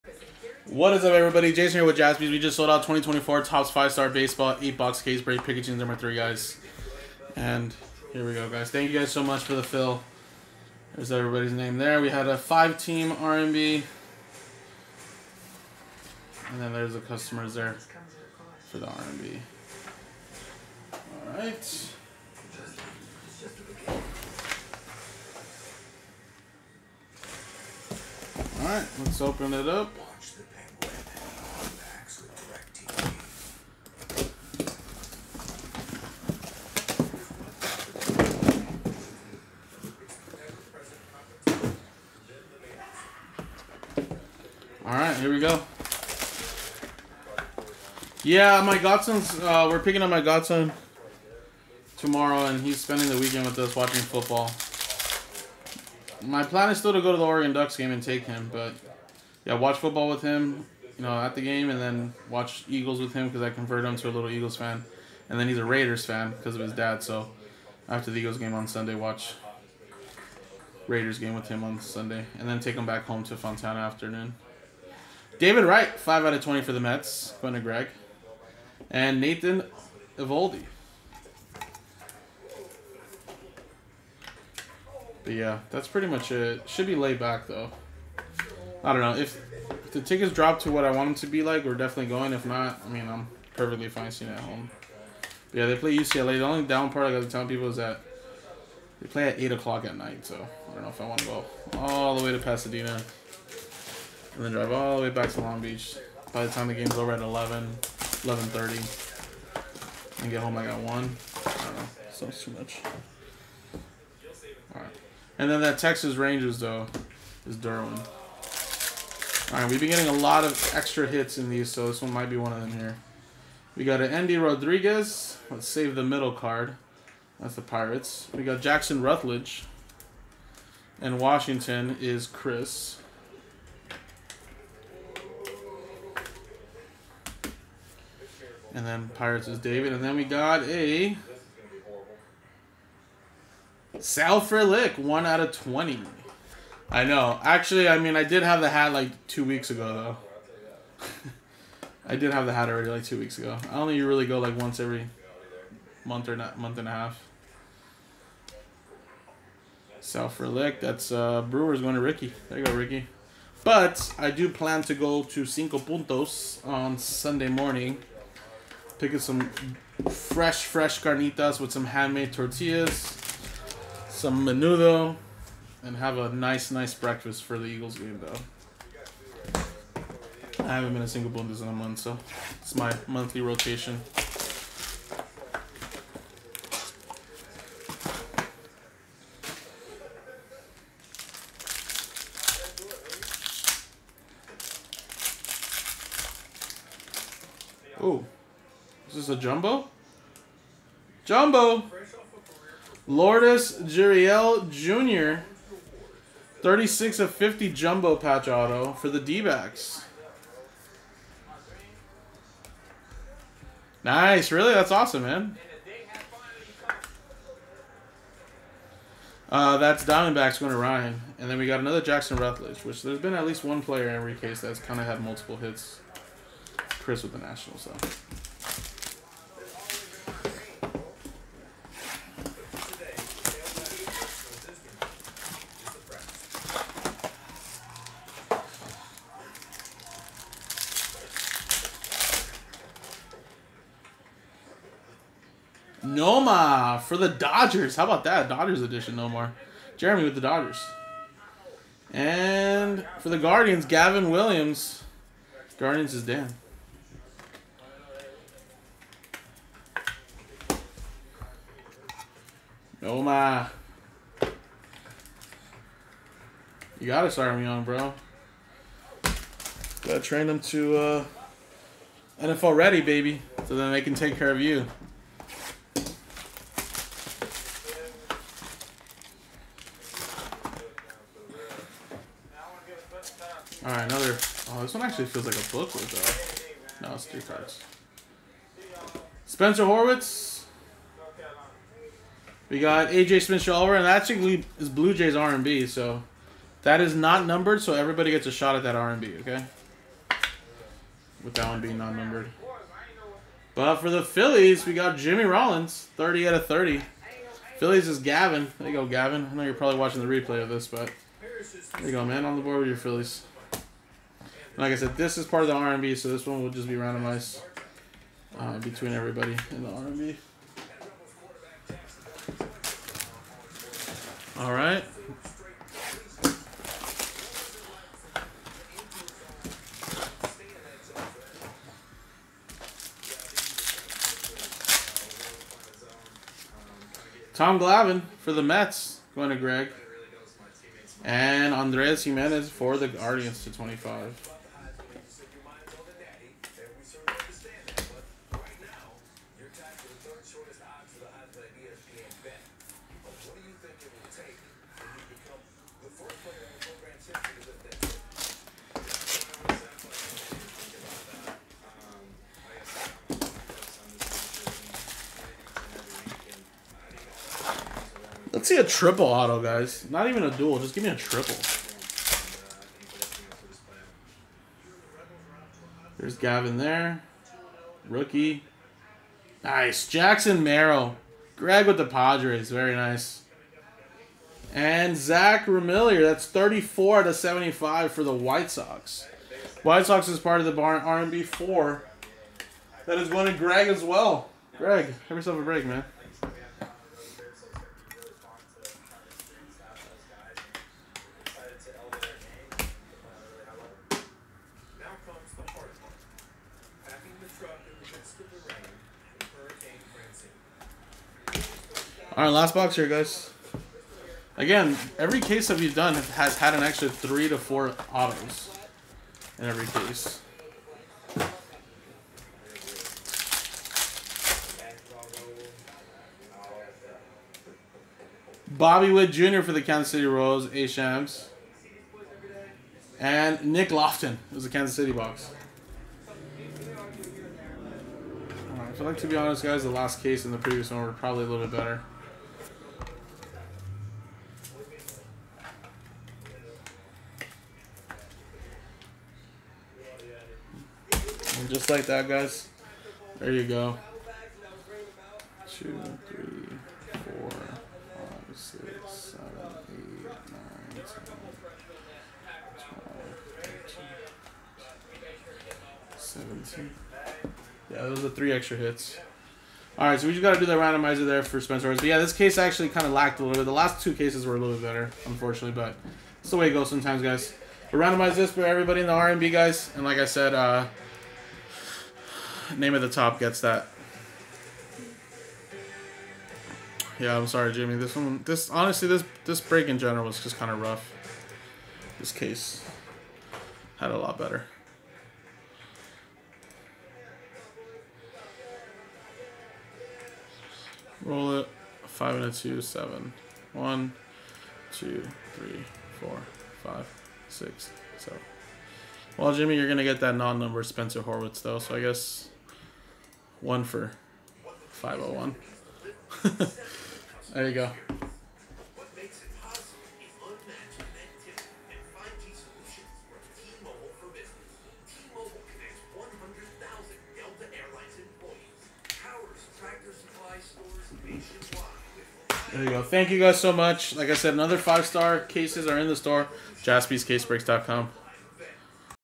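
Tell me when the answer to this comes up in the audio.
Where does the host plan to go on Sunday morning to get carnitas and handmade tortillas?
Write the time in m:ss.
2:45.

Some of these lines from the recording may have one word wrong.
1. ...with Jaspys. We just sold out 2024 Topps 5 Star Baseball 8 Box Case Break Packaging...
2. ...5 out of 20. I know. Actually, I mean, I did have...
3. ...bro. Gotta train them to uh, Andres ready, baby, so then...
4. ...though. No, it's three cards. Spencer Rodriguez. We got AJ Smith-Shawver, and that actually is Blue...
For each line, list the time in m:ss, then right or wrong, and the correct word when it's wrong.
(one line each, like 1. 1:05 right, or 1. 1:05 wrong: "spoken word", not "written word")
1. 0:01 right
2. 2:24 wrong: "1", not "5"
3. 4:27 wrong: "NFL", not "Andres"
4. 4:47 wrong: "Horwitz", not "Rodriguez".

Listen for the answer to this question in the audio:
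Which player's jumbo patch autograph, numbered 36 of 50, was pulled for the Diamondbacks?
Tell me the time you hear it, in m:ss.
3:23.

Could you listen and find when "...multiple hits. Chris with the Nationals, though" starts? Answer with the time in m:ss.
3:45.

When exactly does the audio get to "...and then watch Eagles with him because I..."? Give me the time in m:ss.
1:01.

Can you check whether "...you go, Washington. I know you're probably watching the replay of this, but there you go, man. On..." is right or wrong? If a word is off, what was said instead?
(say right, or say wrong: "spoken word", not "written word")
wrong: "Gavin", not "Washington".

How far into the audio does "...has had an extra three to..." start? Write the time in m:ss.
6:56.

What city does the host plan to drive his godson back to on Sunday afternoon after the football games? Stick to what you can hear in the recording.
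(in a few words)
Fontana.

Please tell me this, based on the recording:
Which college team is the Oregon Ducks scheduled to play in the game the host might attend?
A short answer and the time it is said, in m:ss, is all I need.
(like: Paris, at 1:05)
UCLA, at 1:35.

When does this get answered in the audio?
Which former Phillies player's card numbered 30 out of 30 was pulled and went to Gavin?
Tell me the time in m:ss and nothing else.
5:05.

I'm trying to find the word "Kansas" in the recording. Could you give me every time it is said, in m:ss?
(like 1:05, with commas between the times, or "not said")
7:09, 7:14.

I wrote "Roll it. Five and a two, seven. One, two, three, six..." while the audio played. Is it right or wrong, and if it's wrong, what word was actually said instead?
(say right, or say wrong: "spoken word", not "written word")
wrong: "four", not "six".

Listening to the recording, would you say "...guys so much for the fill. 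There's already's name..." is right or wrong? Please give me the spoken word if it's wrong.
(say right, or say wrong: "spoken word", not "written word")
wrong: "everybody", not "already".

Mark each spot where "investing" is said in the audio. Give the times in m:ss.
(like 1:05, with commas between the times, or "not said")
not said.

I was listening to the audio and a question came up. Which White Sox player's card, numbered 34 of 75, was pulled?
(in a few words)
Zach Remillard.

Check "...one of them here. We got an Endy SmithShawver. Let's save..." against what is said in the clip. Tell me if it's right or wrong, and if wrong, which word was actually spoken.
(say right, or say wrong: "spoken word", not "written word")
wrong: "Rodriguez", not "SmithShawver".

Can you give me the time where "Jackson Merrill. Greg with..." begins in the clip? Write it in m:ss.
6:20.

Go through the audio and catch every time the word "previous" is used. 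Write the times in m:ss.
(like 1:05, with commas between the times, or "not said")
7:20.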